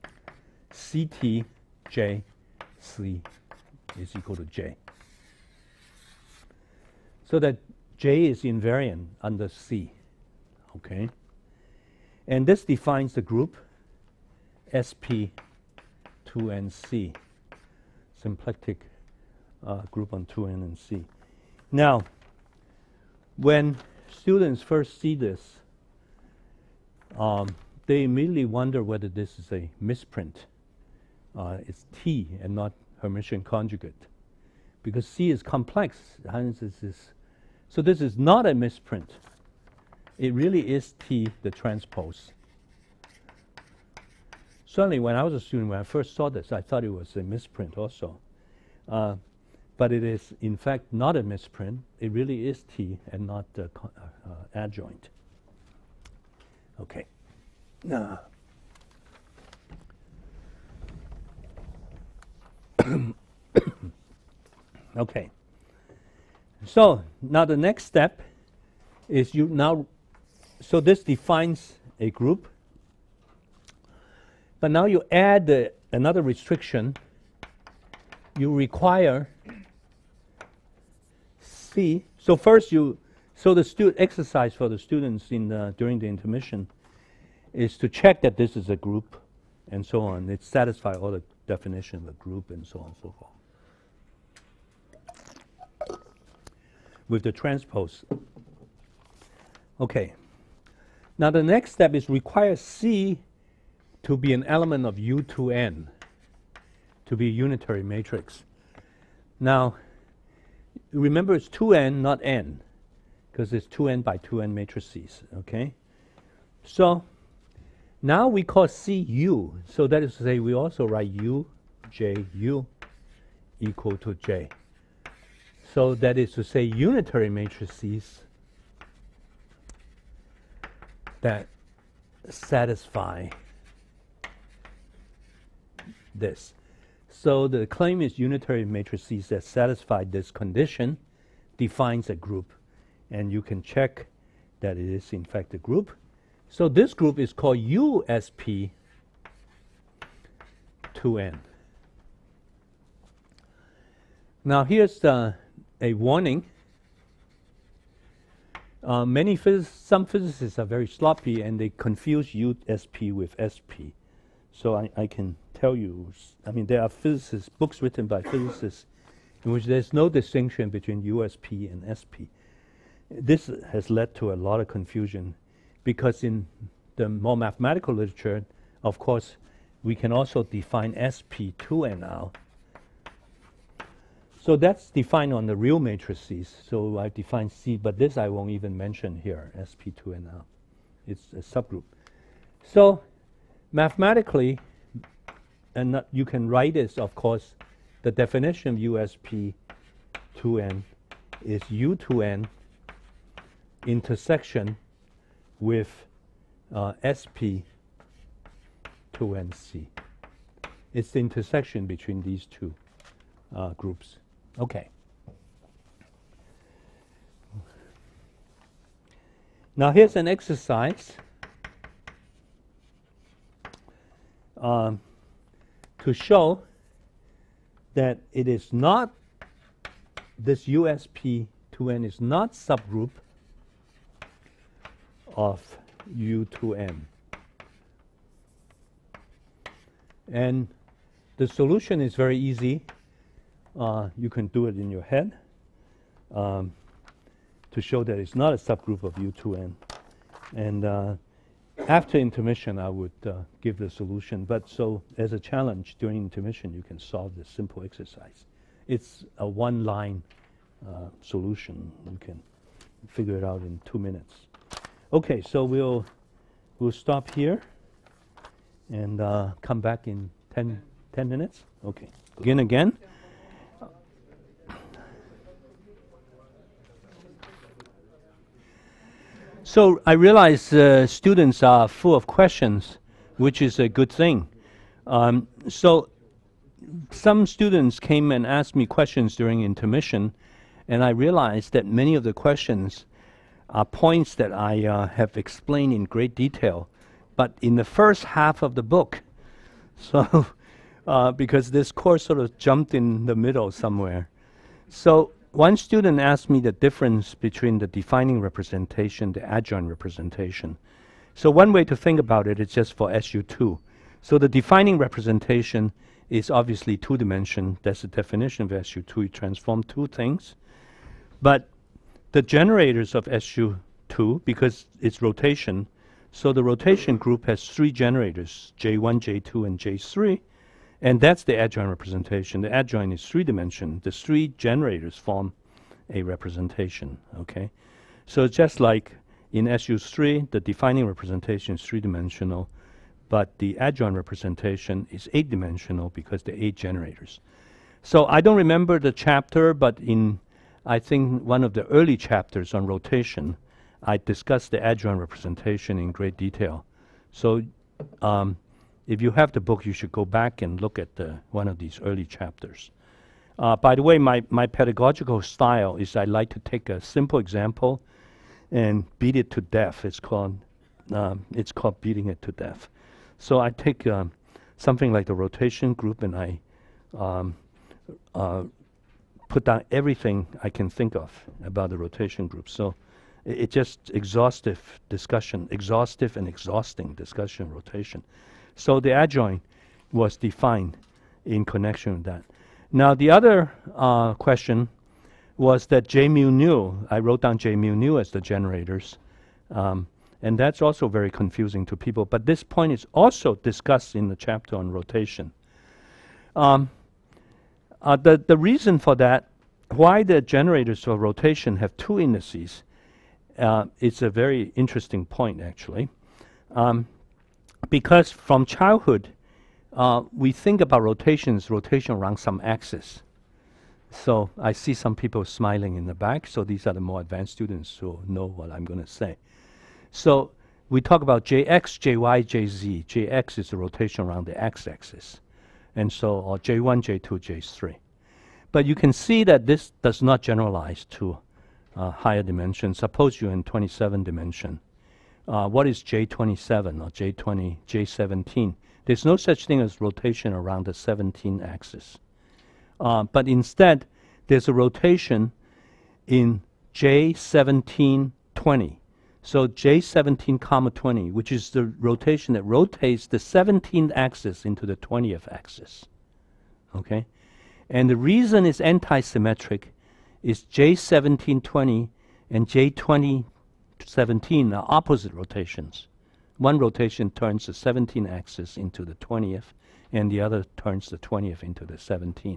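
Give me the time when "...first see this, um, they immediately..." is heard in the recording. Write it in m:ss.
0:24.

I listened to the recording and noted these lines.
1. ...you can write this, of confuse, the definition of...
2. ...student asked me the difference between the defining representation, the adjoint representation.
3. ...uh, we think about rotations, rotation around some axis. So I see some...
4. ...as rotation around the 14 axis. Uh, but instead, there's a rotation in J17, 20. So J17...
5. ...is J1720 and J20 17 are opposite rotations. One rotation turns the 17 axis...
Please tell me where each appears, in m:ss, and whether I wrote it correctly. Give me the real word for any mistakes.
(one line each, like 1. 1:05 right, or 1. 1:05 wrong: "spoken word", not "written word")
1. 3:16 wrong: "course", not "confuse"
2. 5:05 right
3. 6:59 right
4. 7:29 wrong: "17", not "14"
5. 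7:50 right.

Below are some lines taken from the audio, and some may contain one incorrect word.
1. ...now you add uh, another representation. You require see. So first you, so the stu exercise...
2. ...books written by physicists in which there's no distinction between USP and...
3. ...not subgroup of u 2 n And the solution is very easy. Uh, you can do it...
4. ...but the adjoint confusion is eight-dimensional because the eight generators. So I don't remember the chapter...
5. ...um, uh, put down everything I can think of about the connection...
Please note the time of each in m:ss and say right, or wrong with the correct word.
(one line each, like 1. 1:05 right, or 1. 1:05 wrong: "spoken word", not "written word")
1. 1:14 wrong: "restriction", not "representation"
2. 2:47 right
3. 3:52 right
4. 5:43 wrong: "representation", not "confusion"
5. 6:17 wrong: "rotation", not "connection".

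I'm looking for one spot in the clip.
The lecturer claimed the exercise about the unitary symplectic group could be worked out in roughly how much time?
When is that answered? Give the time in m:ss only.
4:23.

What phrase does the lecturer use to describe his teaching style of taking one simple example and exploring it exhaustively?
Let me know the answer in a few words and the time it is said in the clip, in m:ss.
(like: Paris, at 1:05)
Beating it to death, at 6:11.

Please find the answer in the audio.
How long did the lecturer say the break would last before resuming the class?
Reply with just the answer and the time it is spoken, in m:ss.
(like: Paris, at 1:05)
10 minutes, at 4:31.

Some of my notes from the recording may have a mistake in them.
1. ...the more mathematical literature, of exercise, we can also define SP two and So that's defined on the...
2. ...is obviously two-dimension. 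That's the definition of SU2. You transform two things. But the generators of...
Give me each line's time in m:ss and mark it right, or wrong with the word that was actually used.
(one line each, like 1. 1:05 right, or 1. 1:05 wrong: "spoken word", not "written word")
1. 2:56 wrong: "course", not "exercise"
2. 5:16 right.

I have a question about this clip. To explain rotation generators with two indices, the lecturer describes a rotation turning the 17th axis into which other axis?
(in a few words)
20th axis.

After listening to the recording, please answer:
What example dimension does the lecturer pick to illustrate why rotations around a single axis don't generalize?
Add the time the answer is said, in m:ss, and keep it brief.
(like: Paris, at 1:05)
27, at 7:23.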